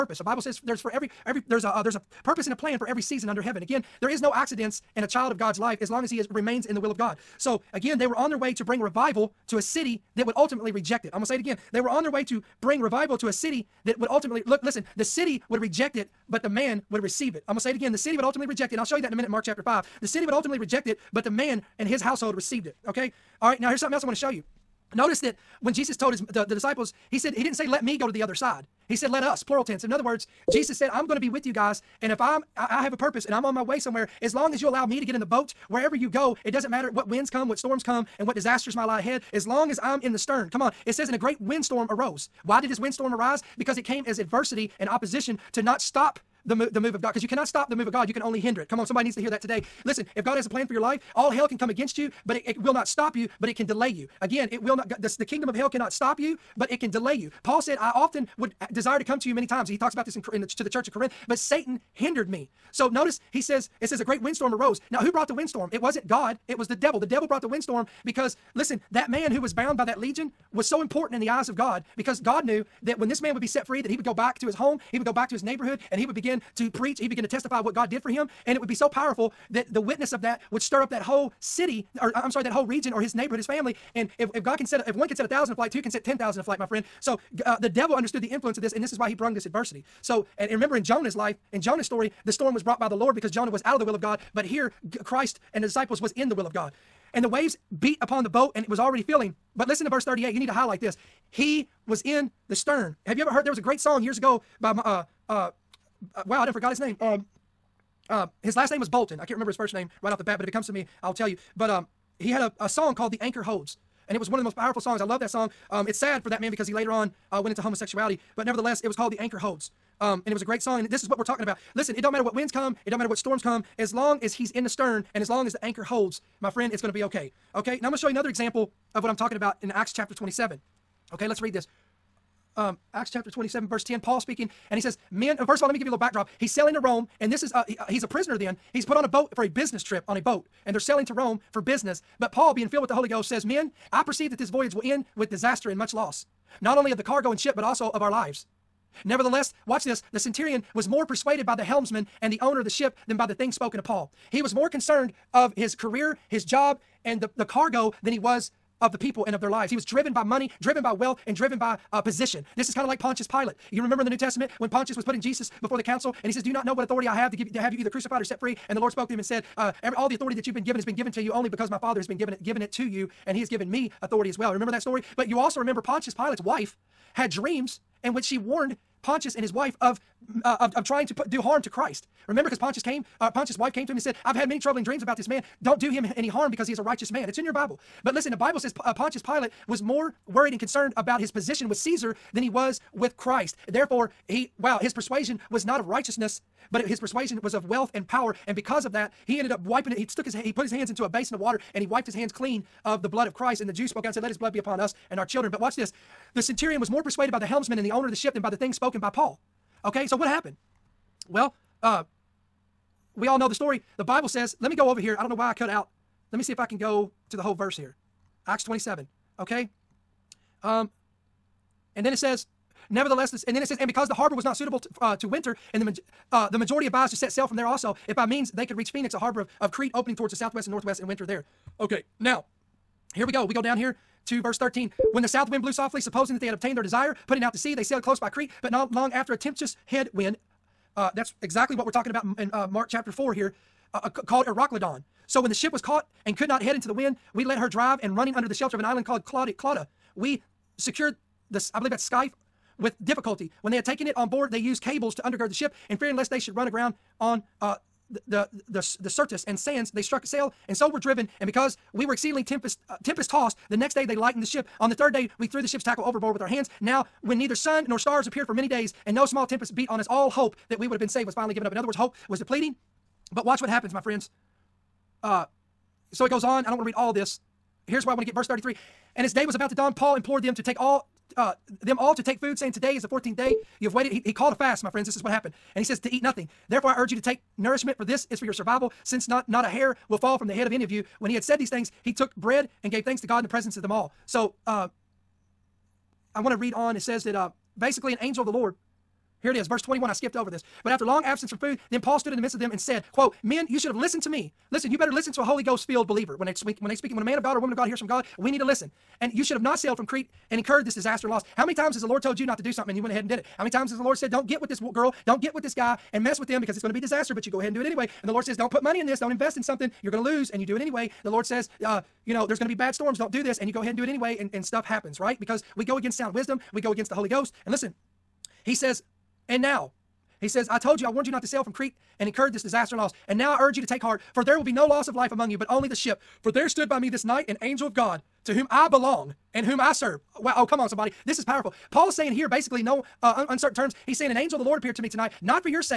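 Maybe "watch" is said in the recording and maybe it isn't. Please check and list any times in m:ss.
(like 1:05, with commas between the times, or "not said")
2:29, 3:25, 4:33.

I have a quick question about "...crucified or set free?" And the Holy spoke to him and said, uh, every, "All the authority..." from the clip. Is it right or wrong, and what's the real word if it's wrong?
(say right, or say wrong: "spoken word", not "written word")
wrong: "Lord", not "Holy".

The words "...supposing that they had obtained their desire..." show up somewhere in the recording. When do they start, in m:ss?
3:56.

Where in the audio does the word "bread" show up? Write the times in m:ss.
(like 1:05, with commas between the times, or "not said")
4:52.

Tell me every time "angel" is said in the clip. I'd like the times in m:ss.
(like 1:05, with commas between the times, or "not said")
4:58, 5:37, 5:44.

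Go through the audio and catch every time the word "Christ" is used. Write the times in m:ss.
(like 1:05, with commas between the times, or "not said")
1:35, 3:01, 3:13, 3:23.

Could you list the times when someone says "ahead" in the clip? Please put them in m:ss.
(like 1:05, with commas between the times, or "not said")
0:38, 5:13, 5:17, 5:23.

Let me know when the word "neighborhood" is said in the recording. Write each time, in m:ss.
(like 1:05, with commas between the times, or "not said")
1:15, 1:23.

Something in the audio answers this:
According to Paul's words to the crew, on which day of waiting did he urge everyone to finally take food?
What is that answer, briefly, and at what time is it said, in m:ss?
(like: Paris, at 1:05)
14th, at 4:43.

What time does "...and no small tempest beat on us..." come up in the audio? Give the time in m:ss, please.
4:29.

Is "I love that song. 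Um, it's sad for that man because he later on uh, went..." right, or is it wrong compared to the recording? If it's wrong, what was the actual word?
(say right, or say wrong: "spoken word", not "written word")
right.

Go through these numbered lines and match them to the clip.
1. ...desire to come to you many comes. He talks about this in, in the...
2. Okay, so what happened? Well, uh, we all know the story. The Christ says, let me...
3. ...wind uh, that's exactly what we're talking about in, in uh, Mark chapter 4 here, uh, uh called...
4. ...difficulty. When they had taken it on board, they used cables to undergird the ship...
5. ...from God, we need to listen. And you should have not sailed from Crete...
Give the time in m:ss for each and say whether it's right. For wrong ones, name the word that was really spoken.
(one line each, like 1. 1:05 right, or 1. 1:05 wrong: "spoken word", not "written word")
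1. 0:58 wrong: "times", not "comes"
2. 3:29 wrong: "Bible", not "Christ"
3. 4:00 right
4. 4:13 right
5. 5:07 right.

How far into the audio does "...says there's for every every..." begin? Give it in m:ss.
0:00.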